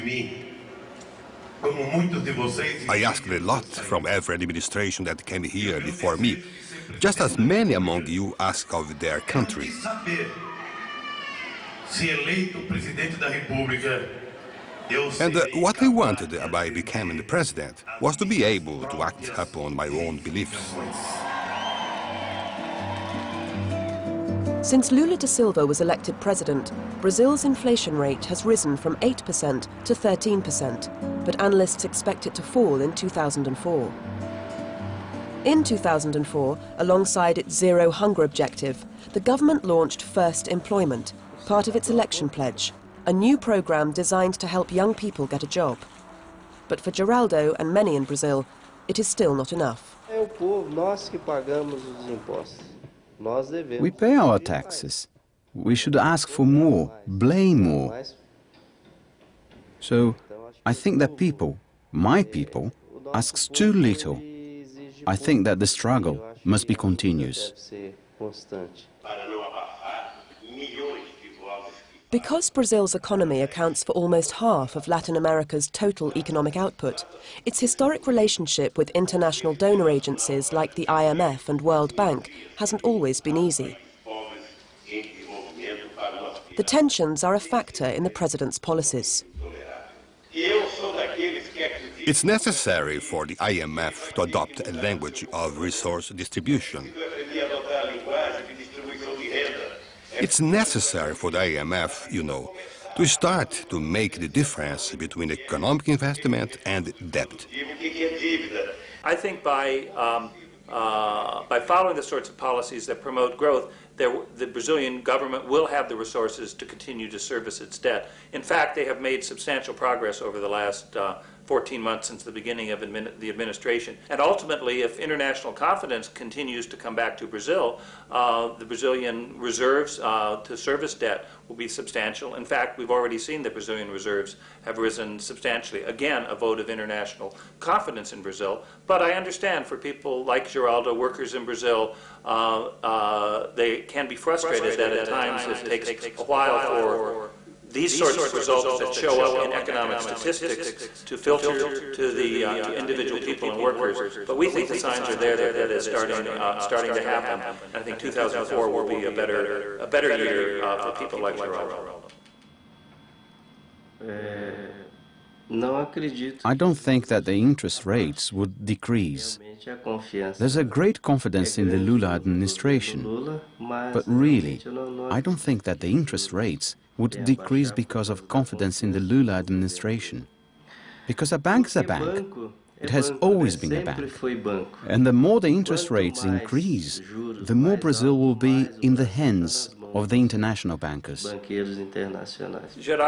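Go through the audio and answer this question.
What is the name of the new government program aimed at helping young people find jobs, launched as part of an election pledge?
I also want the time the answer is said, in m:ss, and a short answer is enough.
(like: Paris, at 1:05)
First Employment, at 0:40.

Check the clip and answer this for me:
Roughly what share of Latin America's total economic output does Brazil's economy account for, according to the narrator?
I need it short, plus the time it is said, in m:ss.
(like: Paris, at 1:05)
almost half, at 1:13.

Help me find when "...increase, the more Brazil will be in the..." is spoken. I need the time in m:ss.
3:06.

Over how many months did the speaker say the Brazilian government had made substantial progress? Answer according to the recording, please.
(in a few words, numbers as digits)
14 months.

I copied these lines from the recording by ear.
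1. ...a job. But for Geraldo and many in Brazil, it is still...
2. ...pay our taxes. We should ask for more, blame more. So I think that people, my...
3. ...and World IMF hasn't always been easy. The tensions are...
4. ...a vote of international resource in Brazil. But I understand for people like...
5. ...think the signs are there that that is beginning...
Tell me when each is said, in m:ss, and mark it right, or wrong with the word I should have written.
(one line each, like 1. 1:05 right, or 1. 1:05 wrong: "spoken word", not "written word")
1. 0:45 right
2. 0:53 right
3. 1:21 wrong: "Bank", not "IMF"
4. 2:16 wrong: "confidence", not "resource"
5. 2:34 wrong: "starting", not "beginning".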